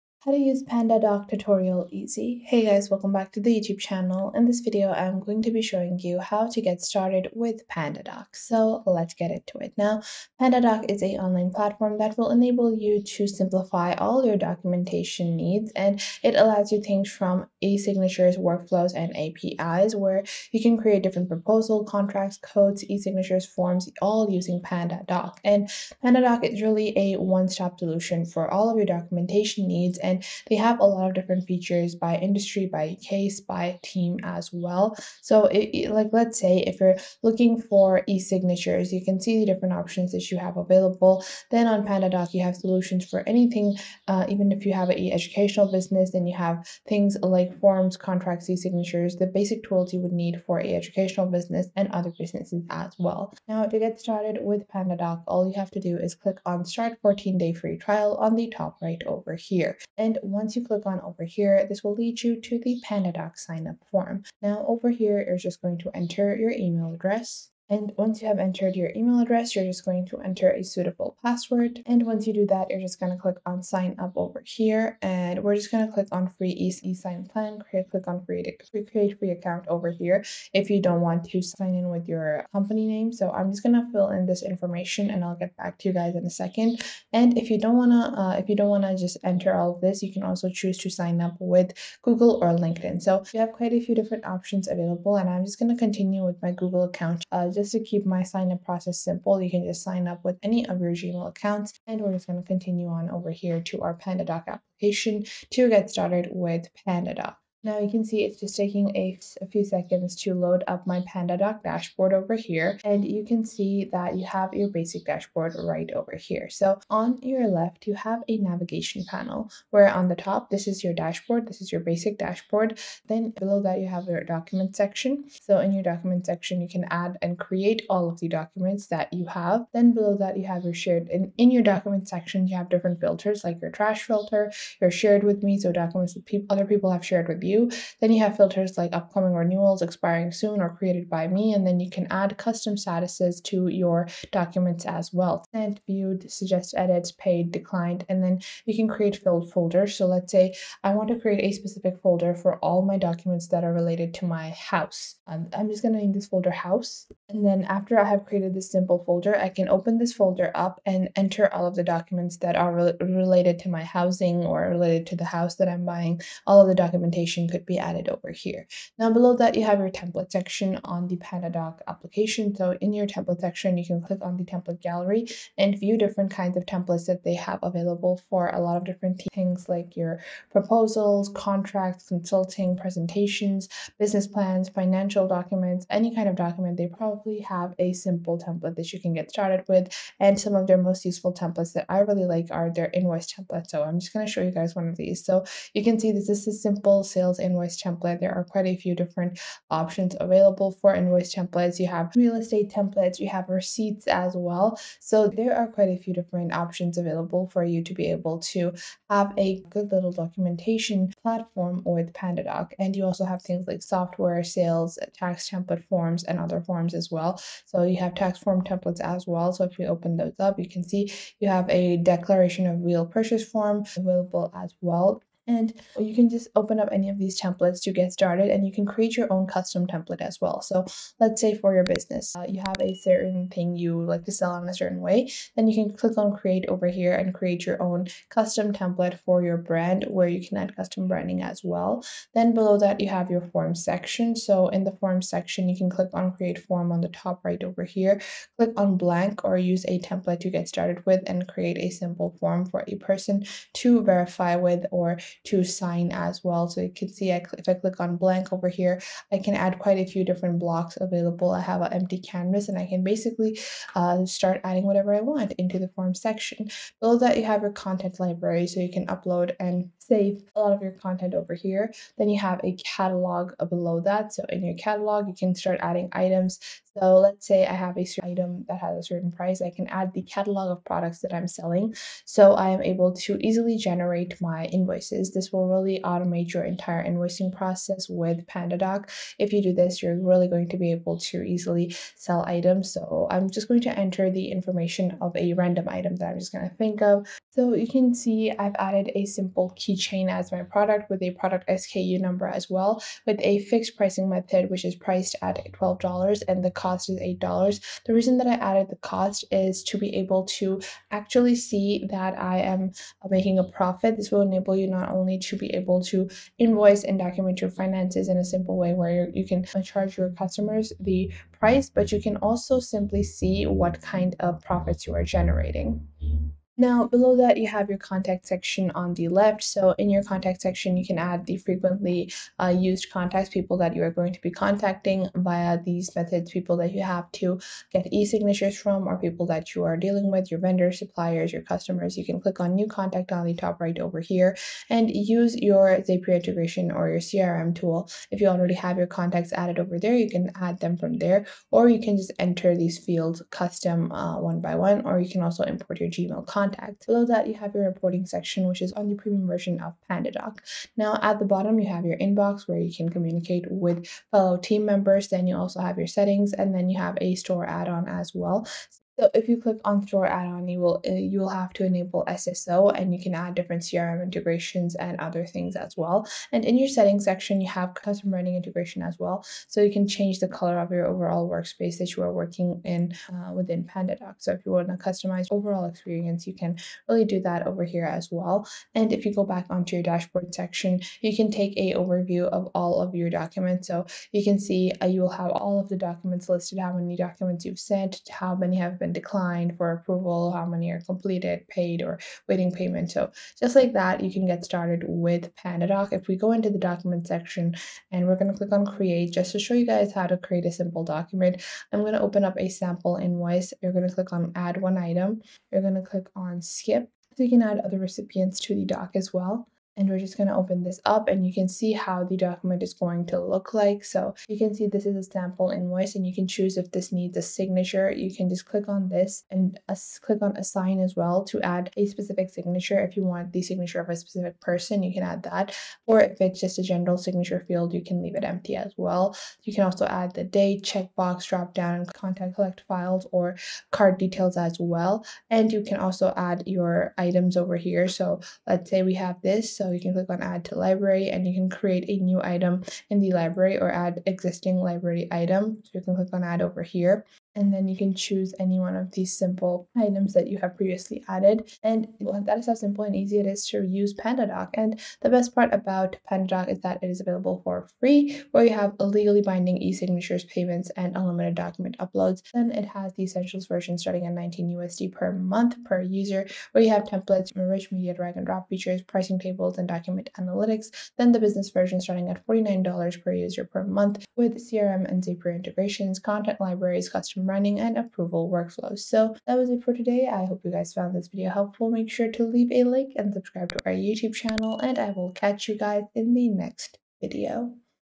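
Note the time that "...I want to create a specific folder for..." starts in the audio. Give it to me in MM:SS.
02:30.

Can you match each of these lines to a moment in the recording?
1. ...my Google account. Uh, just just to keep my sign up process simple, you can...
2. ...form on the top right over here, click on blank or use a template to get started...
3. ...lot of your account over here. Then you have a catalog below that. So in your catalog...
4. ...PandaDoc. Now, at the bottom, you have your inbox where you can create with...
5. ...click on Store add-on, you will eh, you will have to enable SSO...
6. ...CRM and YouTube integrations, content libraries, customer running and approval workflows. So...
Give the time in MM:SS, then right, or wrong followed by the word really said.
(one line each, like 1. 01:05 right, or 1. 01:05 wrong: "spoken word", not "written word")
1. 01:36 right
2. 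04:06 right
3. 04:30 wrong: "content", not "account"
4. 06:00 wrong: "communicate", not "create"
5. 06:09 right
6. 08:04 wrong: "Zapier", not "YouTube".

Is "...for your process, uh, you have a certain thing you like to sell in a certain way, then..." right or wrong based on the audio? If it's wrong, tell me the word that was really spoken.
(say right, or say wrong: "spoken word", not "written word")
wrong: "business", not "process".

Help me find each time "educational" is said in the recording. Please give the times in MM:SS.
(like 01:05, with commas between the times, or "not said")
00:44, 00:50.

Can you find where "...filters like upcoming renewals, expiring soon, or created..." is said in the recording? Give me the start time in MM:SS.
02:18.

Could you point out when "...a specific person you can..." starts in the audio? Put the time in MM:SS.
07:14.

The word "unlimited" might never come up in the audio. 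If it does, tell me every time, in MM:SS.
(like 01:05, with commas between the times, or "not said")
07:51.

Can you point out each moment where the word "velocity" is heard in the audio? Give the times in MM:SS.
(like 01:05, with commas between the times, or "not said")
not said.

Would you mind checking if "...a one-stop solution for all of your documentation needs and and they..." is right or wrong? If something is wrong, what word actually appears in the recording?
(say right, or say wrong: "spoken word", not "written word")
right.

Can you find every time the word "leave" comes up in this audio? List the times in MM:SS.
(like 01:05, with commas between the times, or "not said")
07:18, 08:12.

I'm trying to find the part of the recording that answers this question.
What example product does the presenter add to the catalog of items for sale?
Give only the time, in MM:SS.
04:59.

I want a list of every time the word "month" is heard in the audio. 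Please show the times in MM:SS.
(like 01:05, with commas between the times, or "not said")
07:55, 08:03.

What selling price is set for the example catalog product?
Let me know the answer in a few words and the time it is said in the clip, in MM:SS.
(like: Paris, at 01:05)
$12, at 05:05.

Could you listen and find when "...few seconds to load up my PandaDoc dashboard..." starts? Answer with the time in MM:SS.
01:49.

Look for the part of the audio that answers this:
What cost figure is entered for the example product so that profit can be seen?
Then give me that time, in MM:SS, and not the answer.
05:07.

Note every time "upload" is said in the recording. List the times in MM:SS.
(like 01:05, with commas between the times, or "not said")
04:29, 07:51.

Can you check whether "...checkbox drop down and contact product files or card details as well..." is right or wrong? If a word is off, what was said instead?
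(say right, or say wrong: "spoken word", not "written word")
wrong: "collect", not "product".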